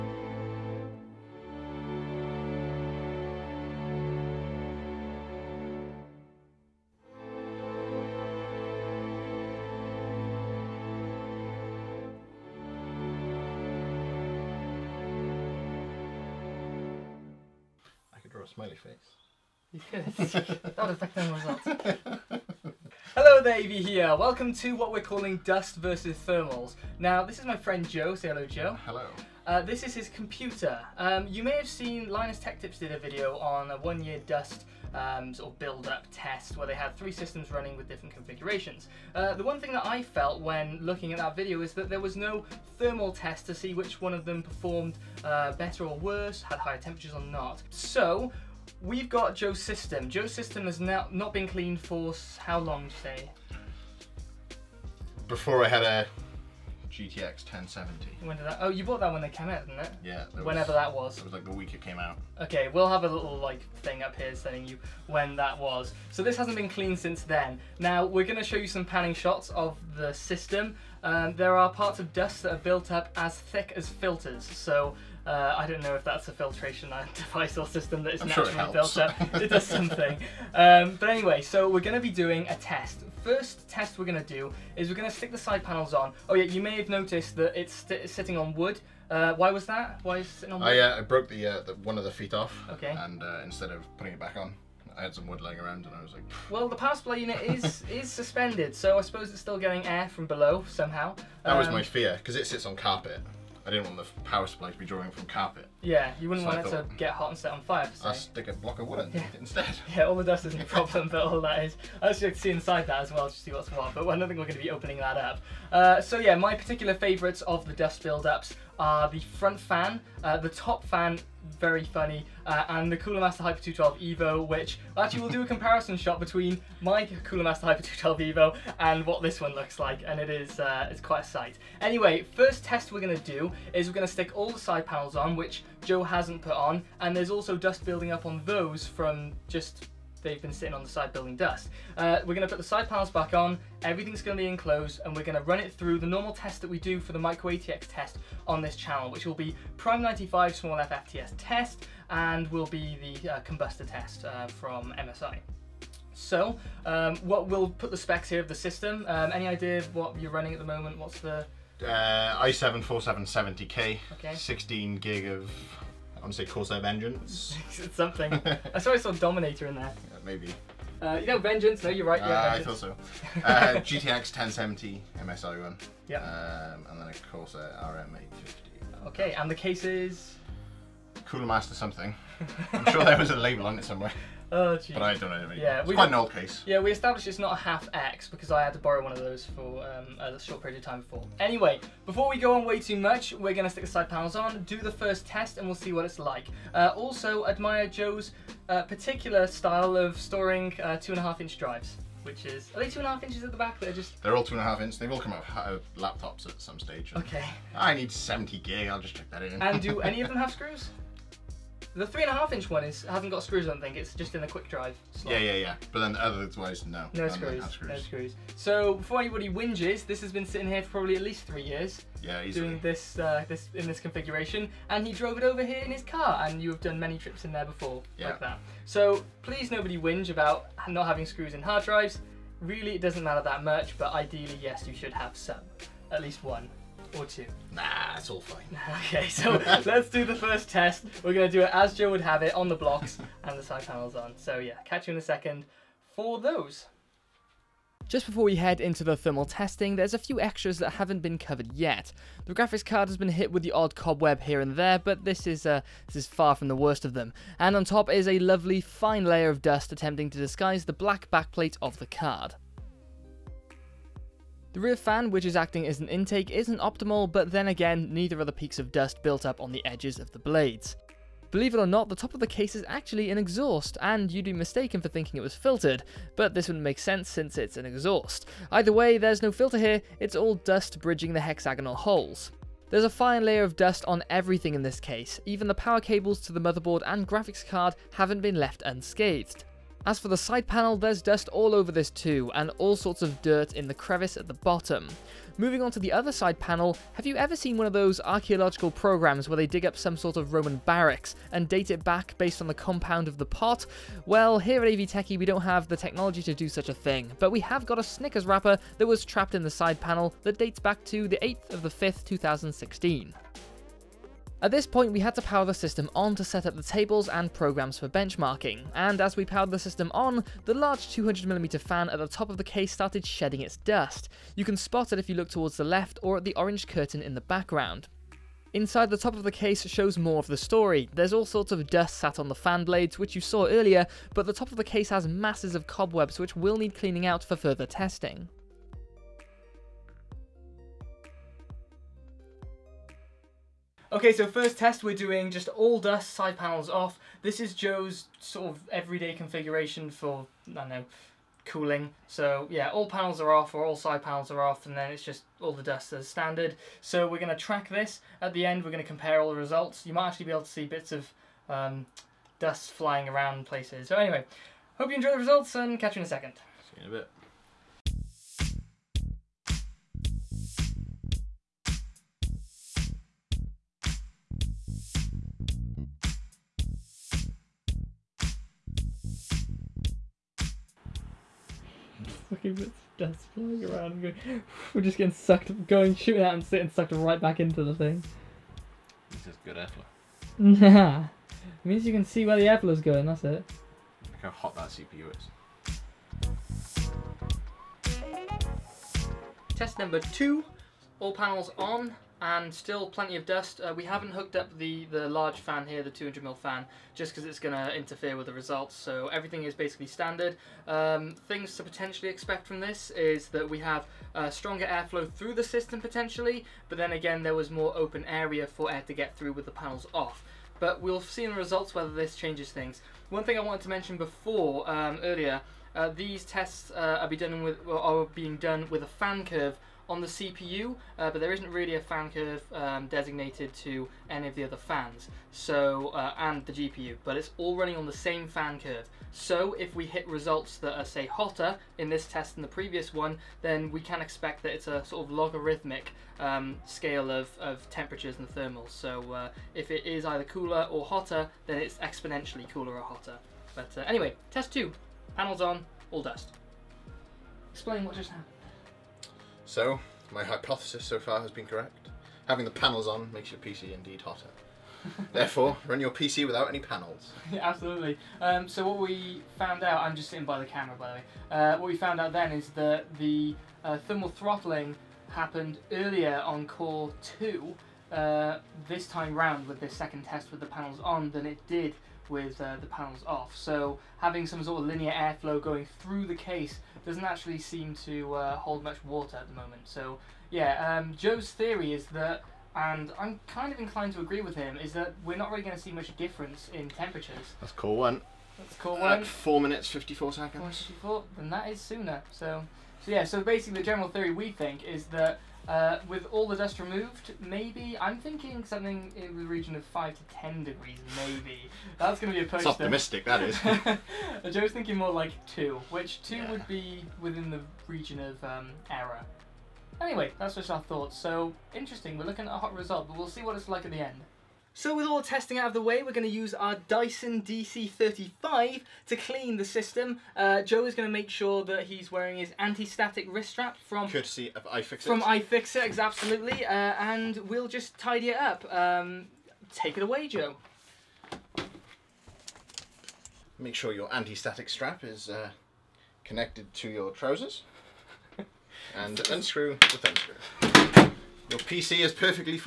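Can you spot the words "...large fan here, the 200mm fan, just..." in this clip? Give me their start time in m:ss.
6:45.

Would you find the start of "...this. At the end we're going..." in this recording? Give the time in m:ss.
5:57.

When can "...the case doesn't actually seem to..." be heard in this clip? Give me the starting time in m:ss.
8:06.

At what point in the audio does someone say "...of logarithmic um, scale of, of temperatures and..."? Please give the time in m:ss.
7:25.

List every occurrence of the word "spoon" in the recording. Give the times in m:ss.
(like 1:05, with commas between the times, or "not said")
not said.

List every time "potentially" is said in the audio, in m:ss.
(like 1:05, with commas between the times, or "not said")
6:51, 6:56.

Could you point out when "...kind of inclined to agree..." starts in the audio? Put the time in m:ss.
8:13.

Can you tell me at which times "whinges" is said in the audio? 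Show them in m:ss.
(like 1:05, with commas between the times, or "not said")
3:39, 3:49.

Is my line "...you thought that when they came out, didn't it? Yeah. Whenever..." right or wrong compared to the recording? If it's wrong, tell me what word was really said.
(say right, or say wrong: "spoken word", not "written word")
wrong: "bought", not "thought".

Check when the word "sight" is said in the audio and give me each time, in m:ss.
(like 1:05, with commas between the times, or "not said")
2:11.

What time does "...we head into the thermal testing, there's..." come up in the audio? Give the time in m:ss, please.
4:08.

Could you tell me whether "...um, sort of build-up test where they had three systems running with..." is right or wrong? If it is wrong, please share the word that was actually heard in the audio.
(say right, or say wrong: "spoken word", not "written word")
right.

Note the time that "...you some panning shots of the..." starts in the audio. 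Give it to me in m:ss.
1:08.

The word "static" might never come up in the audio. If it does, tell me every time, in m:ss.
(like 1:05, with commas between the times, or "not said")
8:52, 9:04.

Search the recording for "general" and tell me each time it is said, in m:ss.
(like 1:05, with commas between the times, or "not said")
8:23.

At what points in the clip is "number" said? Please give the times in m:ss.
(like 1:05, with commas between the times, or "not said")
6:39.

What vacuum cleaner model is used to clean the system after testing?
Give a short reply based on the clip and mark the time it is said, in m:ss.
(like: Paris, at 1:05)
Dyson DC35, at 8:46.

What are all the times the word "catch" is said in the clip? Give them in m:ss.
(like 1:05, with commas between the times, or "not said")
4:04, 6:05.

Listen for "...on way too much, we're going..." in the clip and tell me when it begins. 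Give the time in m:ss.
3:12.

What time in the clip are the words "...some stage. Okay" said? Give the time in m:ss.
3:26.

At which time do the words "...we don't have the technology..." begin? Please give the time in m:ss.
5:05.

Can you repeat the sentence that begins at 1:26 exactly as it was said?
Oh yeah, you may have noticed that it's sitting on wood.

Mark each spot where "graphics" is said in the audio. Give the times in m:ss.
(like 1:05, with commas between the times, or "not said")
4:12, 4:47.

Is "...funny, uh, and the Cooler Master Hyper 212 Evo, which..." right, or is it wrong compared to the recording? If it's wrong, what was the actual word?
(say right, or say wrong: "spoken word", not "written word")
right.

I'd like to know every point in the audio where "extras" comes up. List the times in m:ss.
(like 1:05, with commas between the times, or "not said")
4:10.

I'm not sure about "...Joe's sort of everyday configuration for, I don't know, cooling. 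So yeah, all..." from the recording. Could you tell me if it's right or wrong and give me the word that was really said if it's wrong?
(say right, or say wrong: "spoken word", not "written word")
right.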